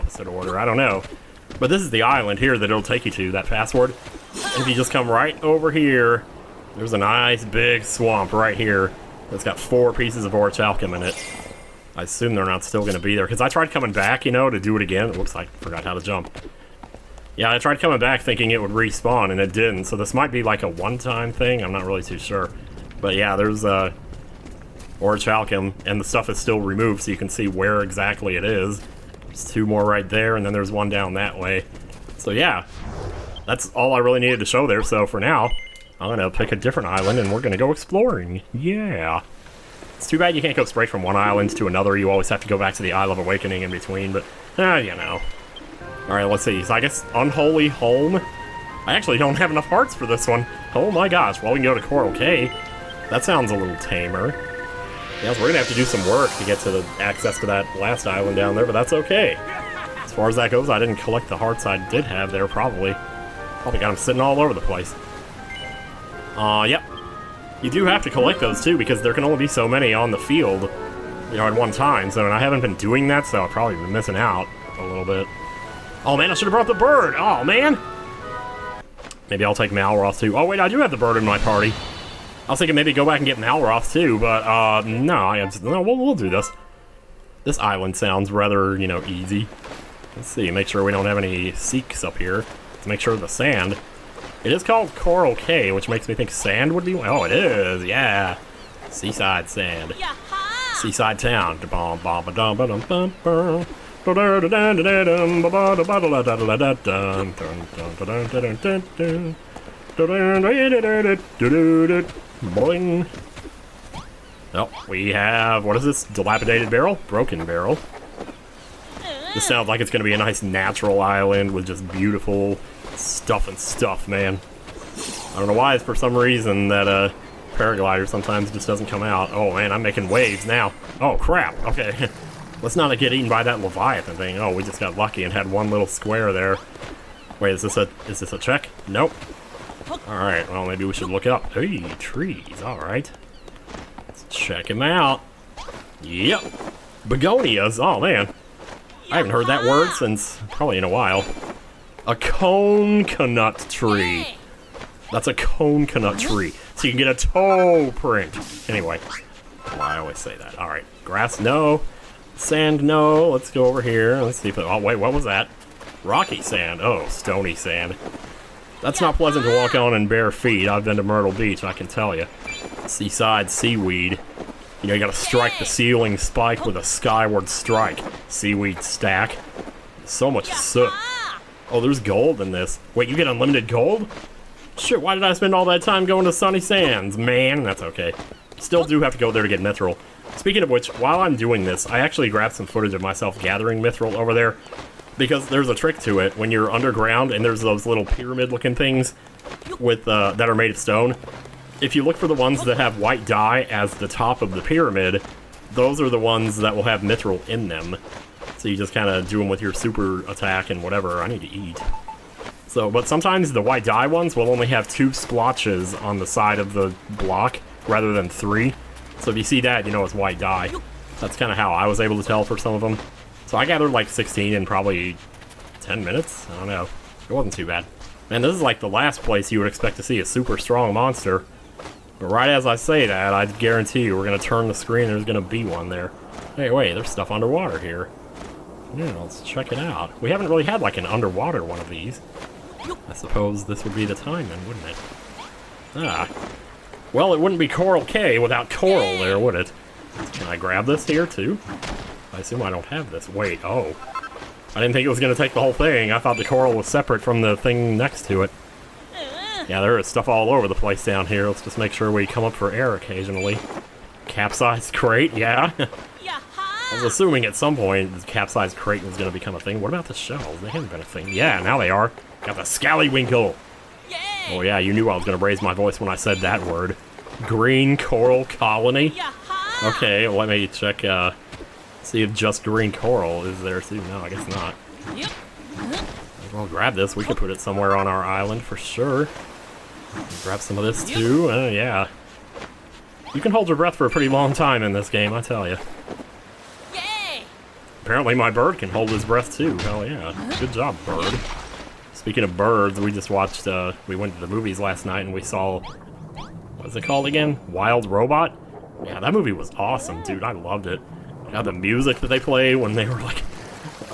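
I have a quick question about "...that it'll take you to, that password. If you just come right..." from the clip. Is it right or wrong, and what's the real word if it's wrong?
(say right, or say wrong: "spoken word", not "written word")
right.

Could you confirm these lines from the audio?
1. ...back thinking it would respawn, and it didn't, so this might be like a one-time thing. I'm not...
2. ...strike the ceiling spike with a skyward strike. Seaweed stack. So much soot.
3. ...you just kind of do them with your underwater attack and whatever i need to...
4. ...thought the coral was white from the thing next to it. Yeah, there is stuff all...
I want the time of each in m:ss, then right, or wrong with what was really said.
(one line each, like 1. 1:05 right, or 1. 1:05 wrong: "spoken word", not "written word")
1. 0:17 right
2. 2:55 right
3. 3:28 wrong: "super", not "underwater"
4. 4:16 wrong: "separate", not "white".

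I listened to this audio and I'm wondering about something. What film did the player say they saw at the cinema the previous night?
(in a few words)
Wild Robot.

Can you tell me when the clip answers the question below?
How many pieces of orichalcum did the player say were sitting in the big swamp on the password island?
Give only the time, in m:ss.
0:09.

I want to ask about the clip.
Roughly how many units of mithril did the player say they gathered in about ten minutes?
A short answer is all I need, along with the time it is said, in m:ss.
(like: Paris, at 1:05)
16, at 3:44.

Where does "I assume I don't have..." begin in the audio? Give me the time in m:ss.
4:12.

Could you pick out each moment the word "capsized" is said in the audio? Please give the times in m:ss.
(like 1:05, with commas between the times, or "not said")
4:24, 4:28.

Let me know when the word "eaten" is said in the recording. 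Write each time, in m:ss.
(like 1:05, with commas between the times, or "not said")
2:13.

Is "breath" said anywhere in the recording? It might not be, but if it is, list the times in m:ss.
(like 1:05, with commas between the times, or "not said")
4:53, 4:59.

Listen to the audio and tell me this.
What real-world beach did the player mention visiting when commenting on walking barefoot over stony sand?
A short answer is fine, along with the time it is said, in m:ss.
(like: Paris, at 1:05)
Myrtle Beach, at 2:51.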